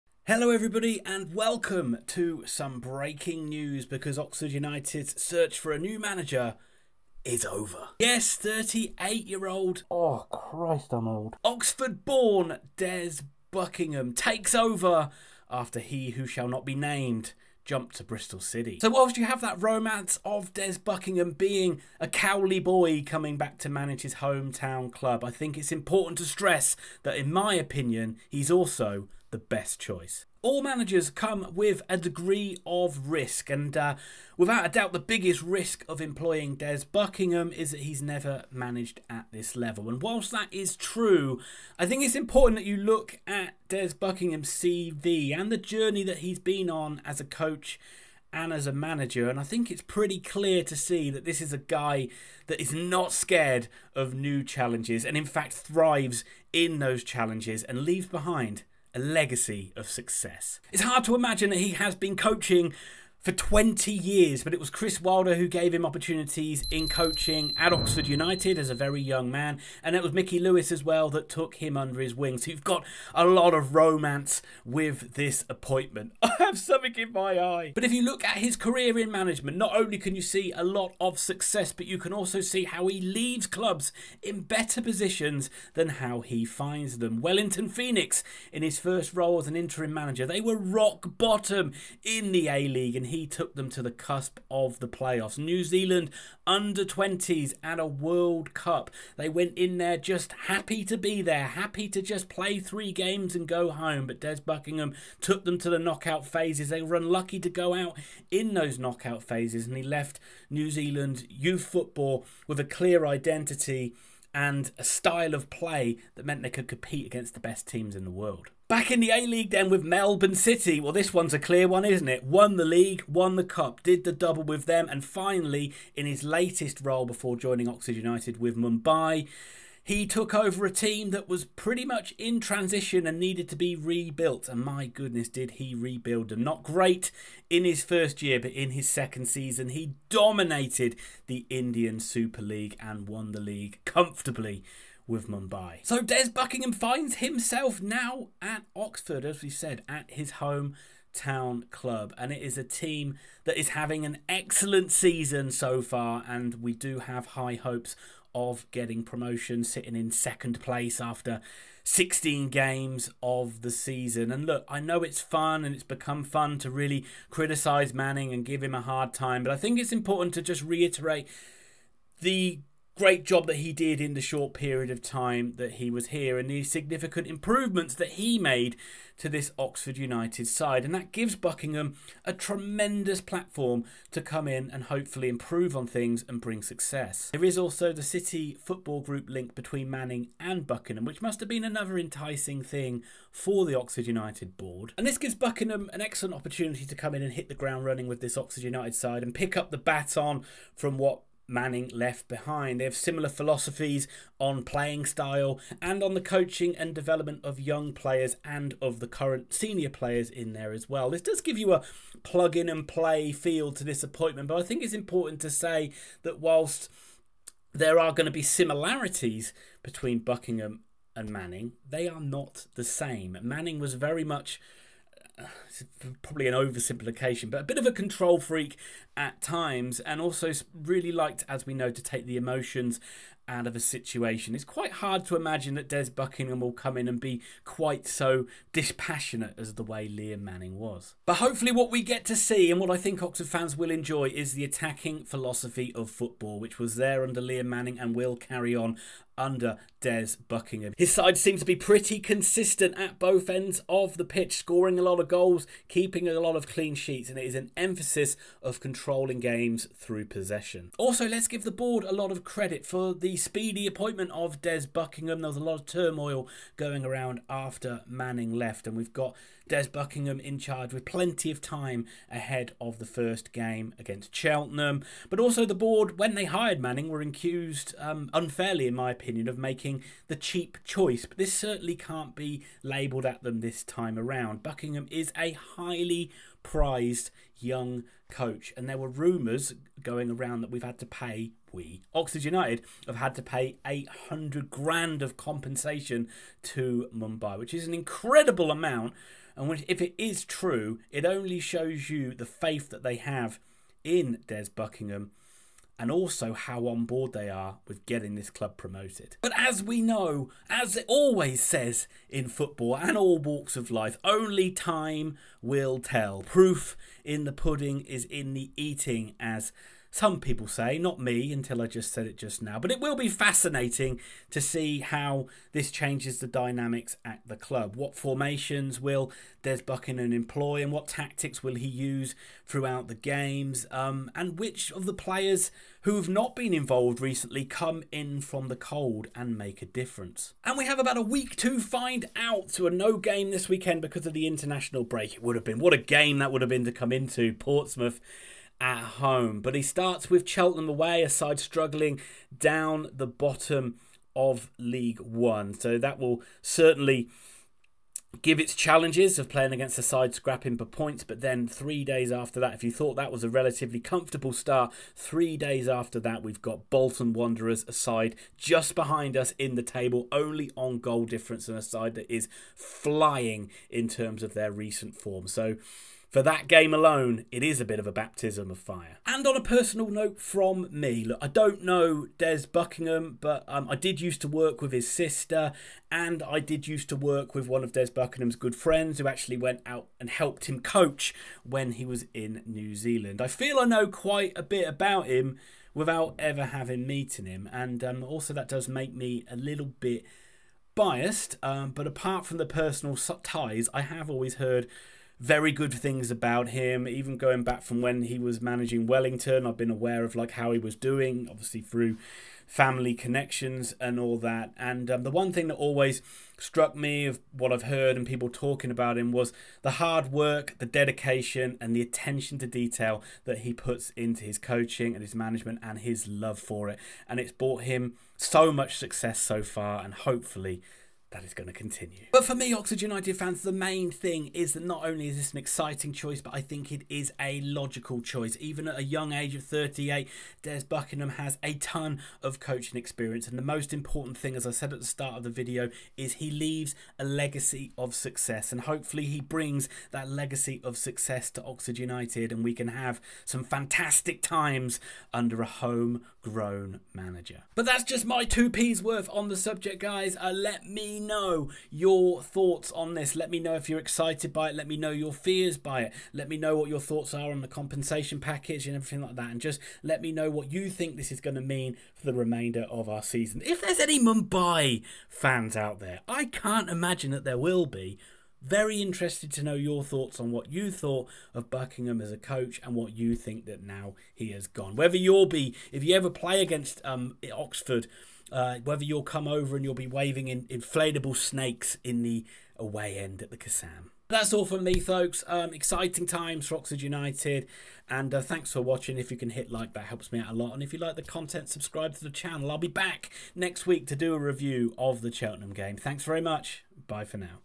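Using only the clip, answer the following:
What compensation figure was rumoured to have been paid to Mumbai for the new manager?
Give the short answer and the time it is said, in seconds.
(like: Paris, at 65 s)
£800,000, at 293 s.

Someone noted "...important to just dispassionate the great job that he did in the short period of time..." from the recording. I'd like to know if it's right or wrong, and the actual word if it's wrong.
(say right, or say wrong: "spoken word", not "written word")
wrong: "reiterate", not "dispassionate".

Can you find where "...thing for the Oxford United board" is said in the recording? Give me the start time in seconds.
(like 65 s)
192 s.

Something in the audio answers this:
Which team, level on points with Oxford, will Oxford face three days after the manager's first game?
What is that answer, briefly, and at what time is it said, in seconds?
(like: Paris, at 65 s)
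Bolton Wanderers, at 366 s.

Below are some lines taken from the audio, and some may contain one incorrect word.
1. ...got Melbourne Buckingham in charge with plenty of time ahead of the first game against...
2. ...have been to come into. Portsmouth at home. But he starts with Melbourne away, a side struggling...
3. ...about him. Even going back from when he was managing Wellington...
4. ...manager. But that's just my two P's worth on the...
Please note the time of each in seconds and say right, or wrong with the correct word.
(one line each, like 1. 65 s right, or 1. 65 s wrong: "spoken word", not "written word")
1. 269 s wrong: "Des", not "Melbourne"
2. 346 s wrong: "Cheltenham", not "Melbourne"
3. 406 s right
4. 457 s right.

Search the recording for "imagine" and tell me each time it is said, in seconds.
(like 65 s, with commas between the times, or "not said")
61 s, 235 s, 476 s.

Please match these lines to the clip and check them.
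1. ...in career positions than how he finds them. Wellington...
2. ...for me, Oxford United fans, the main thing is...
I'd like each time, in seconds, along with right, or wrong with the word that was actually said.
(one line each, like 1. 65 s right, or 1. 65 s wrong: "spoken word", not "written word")
1. 84 s wrong: "better", not "career"
2. 432 s right.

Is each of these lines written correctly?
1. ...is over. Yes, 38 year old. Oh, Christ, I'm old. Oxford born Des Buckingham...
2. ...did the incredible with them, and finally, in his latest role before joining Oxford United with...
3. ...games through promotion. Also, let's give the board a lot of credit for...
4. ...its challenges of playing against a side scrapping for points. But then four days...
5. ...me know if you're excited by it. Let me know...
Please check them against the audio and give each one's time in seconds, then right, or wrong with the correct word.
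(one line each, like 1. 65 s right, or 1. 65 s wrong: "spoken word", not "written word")
1. 7 s right
2. 123 s wrong: "double", not "incredible"
3. 259 s wrong: "possession", not "promotion"
4. 358 s wrong: "three", not "four"
5. 463 s right.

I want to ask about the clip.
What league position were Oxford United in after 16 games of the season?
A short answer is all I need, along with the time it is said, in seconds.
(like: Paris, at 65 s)
Second place, at 160 s.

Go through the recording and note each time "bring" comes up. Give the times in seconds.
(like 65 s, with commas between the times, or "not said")
186 s, 449 s.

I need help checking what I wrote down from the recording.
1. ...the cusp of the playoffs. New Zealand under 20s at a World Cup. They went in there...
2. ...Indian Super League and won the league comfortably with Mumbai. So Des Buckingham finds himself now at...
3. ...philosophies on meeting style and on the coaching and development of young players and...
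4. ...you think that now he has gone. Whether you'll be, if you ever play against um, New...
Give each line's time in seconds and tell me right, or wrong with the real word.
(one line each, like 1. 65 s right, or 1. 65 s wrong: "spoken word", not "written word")
1. 93 s right
2. 141 s right
3. 203 s wrong: "playing", not "meeting"
4. 483 s wrong: "Oxford", not "New".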